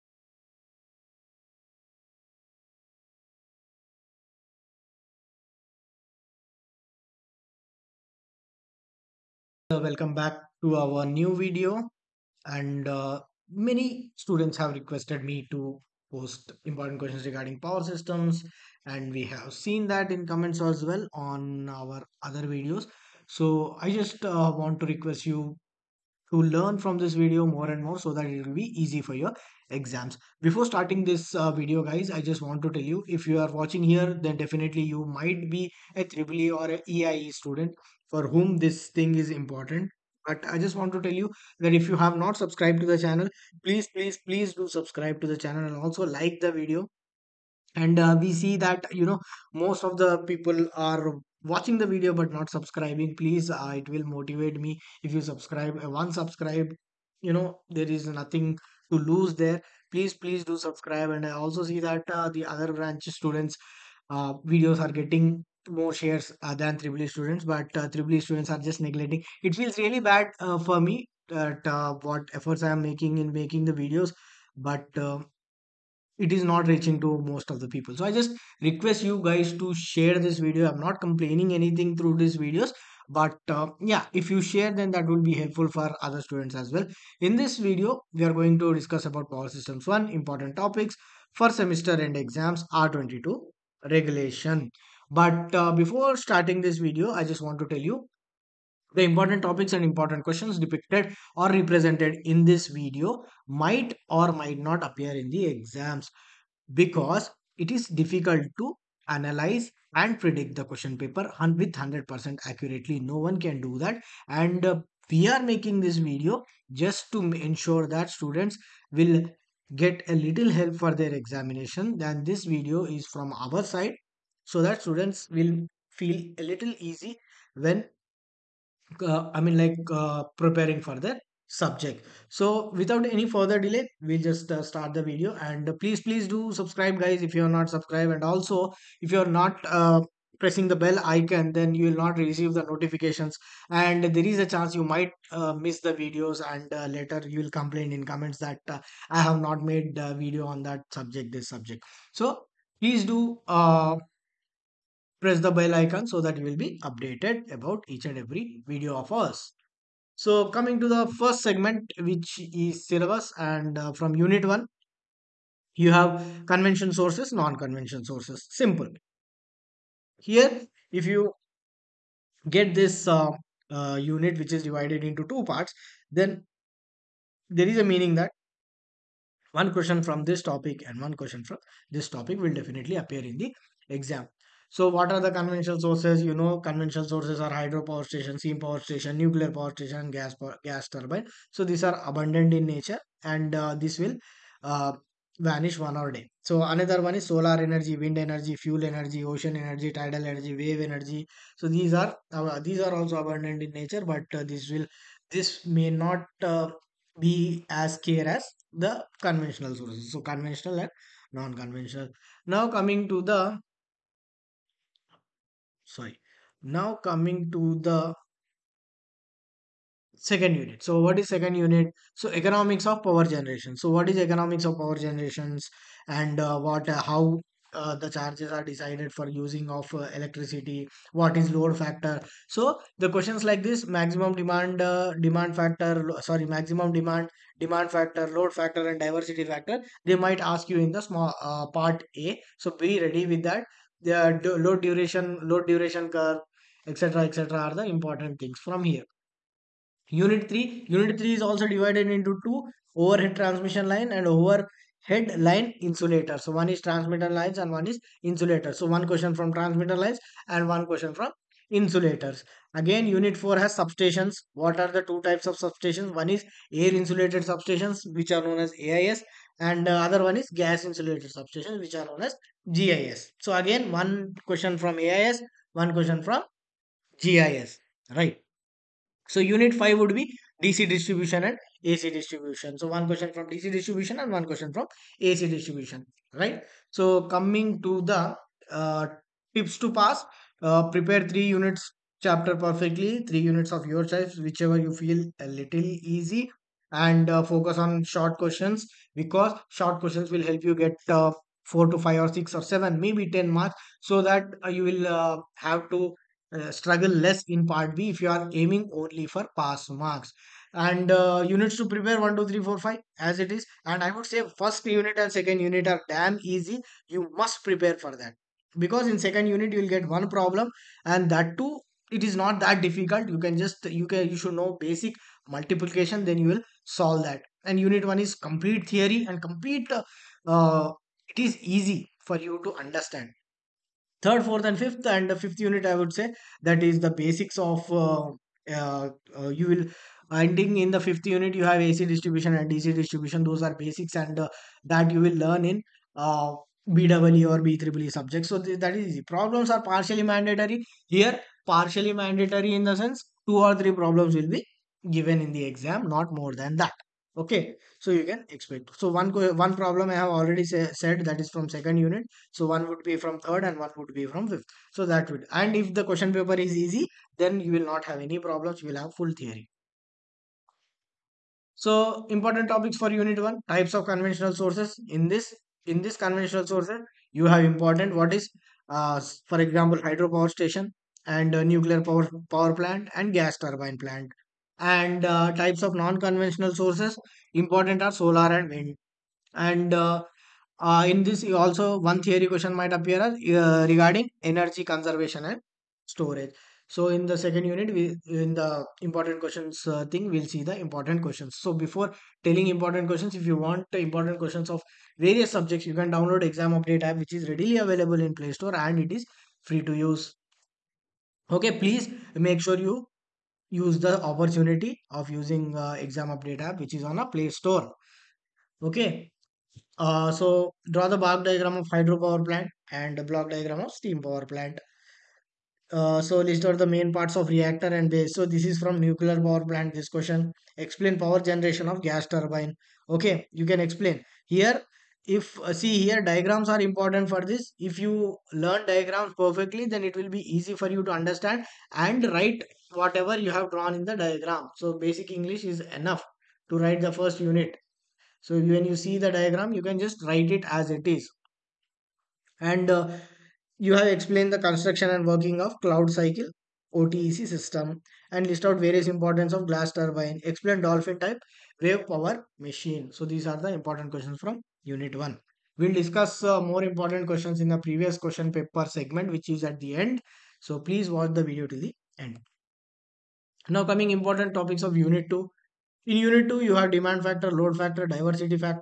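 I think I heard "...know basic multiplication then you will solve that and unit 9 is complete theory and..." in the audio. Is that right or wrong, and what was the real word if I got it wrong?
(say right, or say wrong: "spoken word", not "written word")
wrong: "1", not "9".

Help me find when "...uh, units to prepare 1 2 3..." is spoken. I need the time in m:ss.
5:11.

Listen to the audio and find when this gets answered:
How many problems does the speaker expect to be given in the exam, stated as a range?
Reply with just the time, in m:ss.
5:53.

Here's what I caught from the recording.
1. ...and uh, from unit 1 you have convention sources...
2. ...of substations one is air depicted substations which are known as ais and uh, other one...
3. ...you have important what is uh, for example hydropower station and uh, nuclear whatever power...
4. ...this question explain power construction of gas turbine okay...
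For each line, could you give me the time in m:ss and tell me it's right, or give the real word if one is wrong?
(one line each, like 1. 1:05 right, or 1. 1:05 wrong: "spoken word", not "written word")
1. 2:43 right
2. 4:25 wrong: "insulated", not "depicted"
3. 6:17 wrong: "power", not "whatever"
4. 7:09 wrong: "generation", not "construction".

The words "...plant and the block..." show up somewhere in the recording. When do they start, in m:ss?
7:02.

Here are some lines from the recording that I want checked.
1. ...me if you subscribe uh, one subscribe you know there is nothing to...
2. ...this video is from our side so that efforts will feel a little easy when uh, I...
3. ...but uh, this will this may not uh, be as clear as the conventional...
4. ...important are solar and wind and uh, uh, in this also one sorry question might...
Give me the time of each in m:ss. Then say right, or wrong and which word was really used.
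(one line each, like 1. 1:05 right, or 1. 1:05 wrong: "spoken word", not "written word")
1. 0:54 right
2. 2:02 wrong: "students", not "efforts"
3. 3:24 right
4. 6:27 wrong: "theory", not "sorry".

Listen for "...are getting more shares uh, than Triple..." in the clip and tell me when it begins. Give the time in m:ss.
1:04.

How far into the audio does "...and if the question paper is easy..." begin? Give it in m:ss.
6:05.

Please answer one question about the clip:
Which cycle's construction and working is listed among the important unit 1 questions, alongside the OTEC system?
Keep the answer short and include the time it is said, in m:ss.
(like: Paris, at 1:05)
Claude cycle, at 7:35.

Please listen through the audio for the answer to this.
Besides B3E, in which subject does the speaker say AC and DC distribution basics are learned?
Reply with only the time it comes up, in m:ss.
5:46.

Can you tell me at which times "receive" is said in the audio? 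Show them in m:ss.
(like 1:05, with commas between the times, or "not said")
2:22.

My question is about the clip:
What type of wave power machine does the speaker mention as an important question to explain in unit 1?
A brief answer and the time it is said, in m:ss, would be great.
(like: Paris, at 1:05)
Dolphin type, at 7:40.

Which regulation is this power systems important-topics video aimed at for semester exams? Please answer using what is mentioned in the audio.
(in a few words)
R22.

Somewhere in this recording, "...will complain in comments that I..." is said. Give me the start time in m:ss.
2:27.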